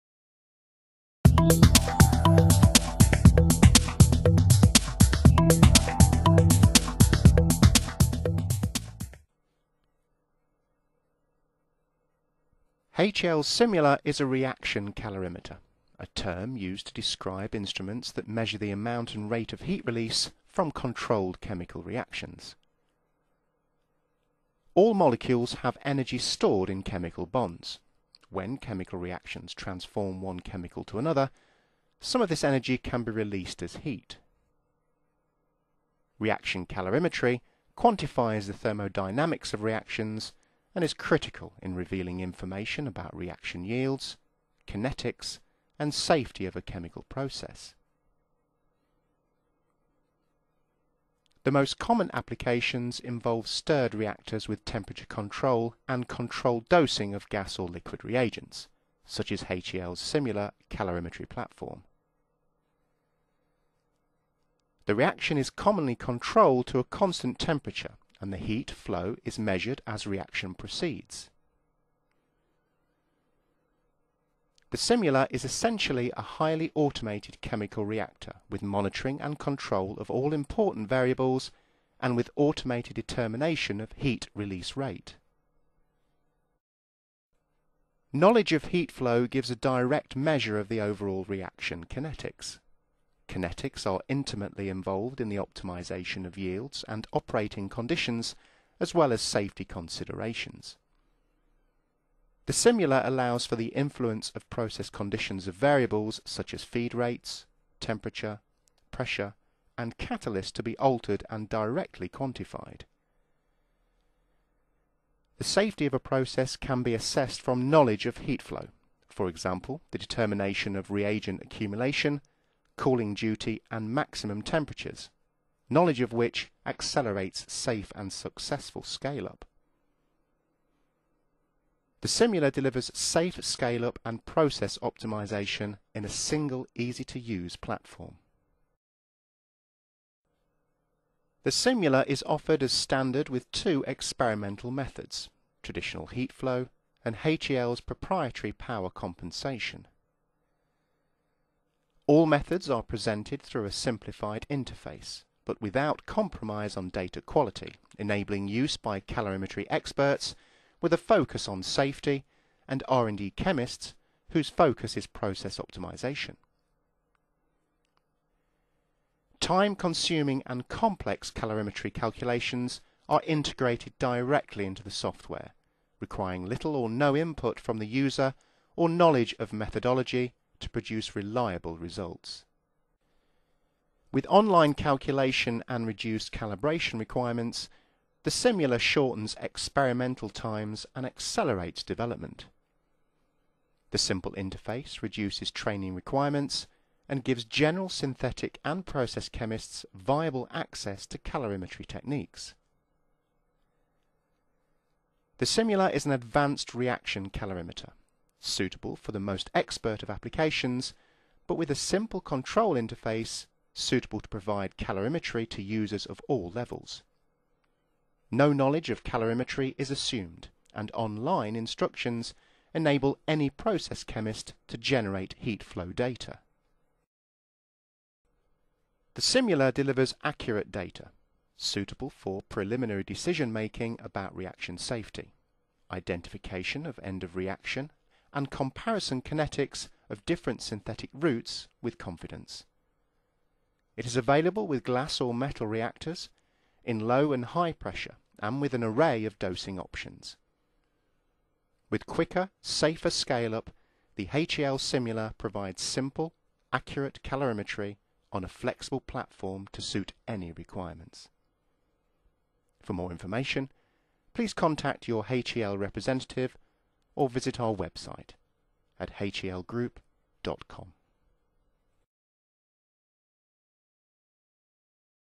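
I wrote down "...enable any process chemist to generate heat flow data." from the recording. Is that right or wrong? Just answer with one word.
right.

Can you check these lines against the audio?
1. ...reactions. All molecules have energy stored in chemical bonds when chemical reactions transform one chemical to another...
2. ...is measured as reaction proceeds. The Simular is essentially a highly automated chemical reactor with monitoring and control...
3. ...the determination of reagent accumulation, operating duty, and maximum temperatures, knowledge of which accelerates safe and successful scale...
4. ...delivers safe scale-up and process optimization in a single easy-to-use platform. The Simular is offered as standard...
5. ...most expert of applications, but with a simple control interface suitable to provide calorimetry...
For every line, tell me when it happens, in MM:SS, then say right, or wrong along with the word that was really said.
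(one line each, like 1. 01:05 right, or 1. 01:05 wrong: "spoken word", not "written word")
1. 00:21 right
2. 01:09 right
3. 01:59 wrong: "cooling", not "operating"
4. 02:12 right
5. 03:29 right.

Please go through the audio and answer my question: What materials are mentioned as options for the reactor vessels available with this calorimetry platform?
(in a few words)
glass or metal.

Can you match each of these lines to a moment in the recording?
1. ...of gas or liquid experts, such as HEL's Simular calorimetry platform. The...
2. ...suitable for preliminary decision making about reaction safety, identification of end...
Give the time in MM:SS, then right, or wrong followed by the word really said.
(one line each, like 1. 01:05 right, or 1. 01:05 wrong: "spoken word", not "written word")
1. 00:57 wrong: "reagents", not "experts"
2. 03:51 right.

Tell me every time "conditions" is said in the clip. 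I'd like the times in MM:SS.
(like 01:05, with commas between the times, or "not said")
01:37, 01:44.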